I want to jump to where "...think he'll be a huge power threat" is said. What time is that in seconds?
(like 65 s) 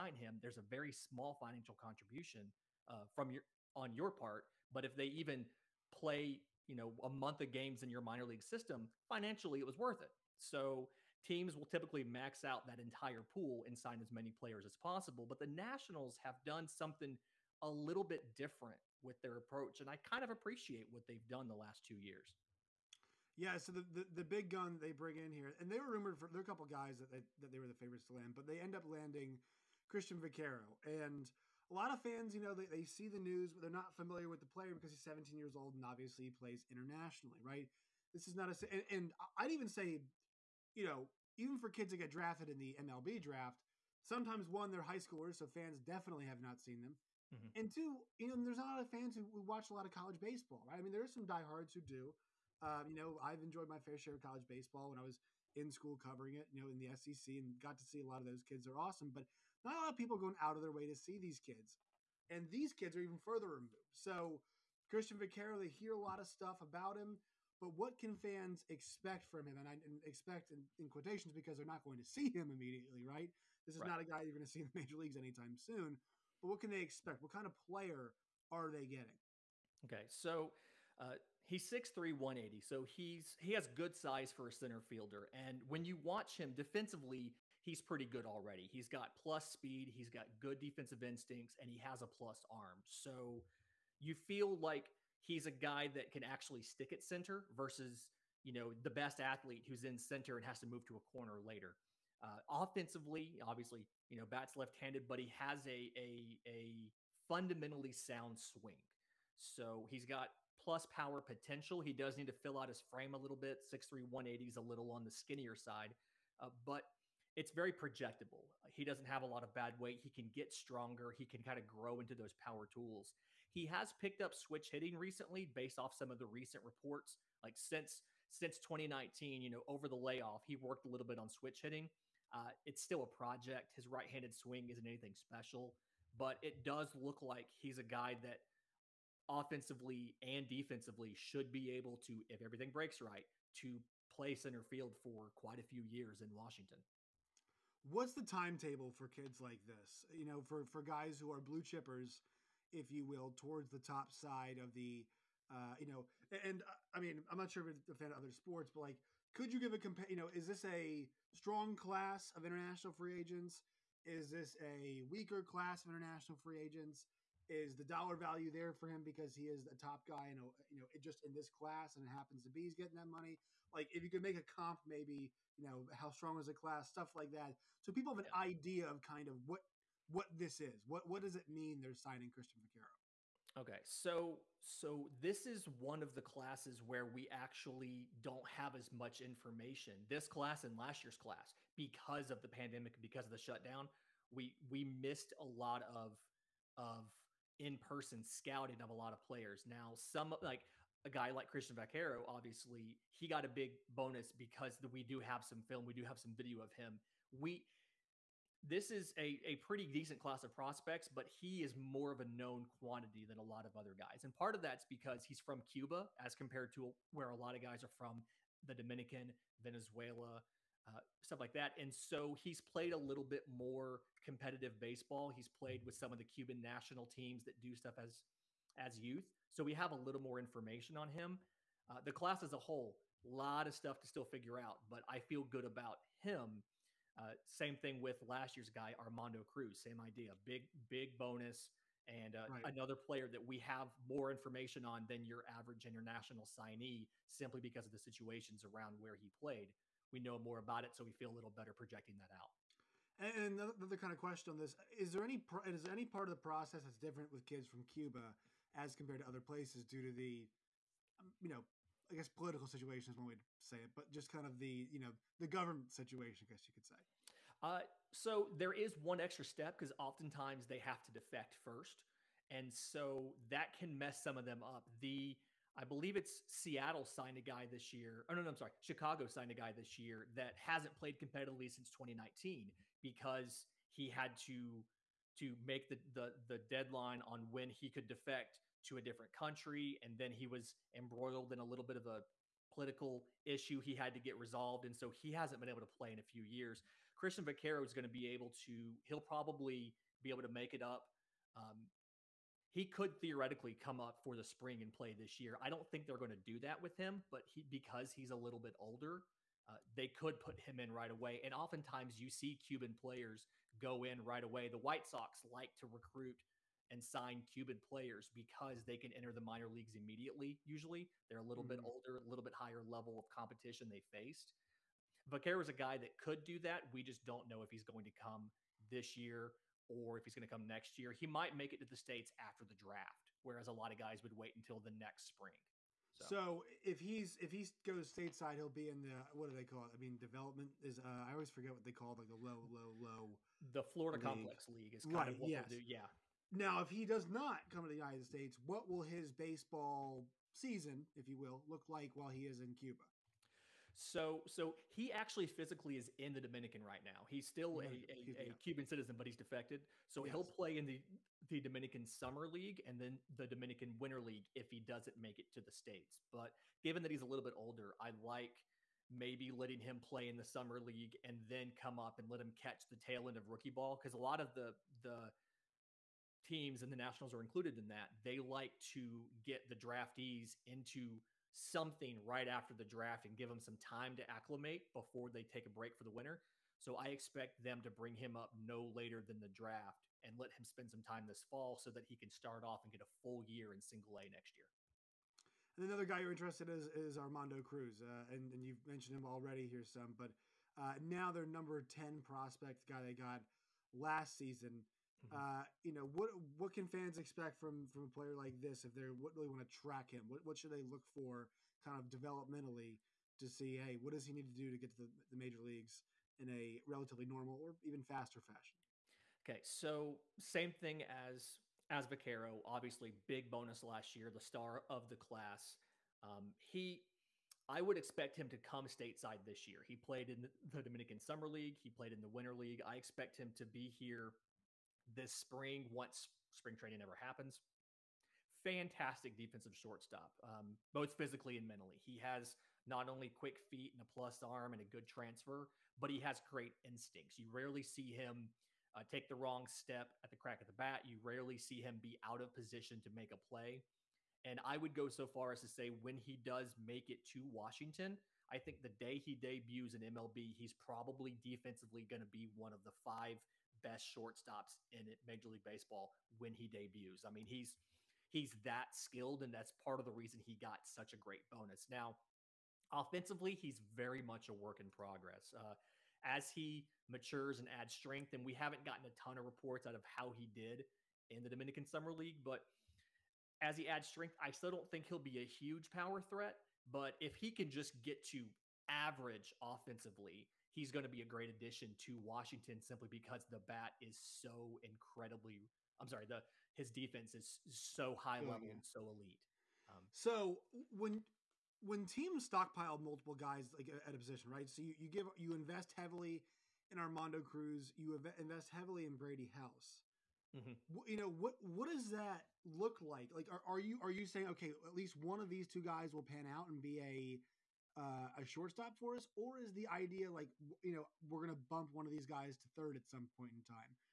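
484 s.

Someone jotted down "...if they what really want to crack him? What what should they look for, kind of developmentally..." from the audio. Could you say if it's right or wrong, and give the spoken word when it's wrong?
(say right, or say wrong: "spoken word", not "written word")
wrong: "track", not "crack".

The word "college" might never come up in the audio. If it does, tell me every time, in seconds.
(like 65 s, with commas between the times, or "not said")
49 s, 54 s.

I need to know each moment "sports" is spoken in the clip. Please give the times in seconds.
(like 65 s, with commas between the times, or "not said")
158 s.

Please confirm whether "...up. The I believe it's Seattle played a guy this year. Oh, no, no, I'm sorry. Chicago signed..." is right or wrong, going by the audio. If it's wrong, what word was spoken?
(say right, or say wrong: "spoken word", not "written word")
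wrong: "signed", not "played".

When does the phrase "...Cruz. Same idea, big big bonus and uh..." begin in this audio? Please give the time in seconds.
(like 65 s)
239 s.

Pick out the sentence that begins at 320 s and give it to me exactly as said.
Usually they're a little mm -hmm.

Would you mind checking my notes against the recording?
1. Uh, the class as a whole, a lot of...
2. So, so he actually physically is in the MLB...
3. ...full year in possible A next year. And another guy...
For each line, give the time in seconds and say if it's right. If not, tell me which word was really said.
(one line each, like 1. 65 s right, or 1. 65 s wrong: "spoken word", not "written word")
1. 231 s right
2. 353 s wrong: "Dominican", not "MLB"
3. 393 s wrong: "single", not "possible".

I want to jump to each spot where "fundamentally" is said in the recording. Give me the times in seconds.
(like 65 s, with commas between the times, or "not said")
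107 s.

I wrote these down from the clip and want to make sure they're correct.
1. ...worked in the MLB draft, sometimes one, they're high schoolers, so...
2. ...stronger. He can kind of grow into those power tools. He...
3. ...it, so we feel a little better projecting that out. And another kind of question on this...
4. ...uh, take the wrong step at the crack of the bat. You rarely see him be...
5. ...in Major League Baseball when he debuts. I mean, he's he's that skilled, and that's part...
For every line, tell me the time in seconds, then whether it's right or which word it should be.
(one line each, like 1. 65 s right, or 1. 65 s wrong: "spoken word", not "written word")
1. 42 s wrong: "drafted", not "worked"
2. 120 s right
3. 250 s right
4. 448 s right
5. 464 s right.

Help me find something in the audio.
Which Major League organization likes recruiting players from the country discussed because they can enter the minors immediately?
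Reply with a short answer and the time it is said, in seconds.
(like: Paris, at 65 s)
White Sox, at 314 s.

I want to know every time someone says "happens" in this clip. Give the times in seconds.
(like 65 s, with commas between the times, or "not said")
172 s, 437 s.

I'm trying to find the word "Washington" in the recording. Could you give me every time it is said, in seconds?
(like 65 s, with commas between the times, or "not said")
146 s, 457 s, 492 s.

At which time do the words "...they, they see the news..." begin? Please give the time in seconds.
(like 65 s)
32 s.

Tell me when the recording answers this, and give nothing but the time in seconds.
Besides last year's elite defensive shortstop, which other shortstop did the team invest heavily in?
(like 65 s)
509 s.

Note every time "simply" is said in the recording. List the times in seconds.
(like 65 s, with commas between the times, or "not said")
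247 s, 492 s.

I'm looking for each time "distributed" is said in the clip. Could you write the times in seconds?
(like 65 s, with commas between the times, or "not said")
not said.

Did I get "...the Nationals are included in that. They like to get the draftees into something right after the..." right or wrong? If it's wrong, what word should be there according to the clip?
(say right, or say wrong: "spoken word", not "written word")
right.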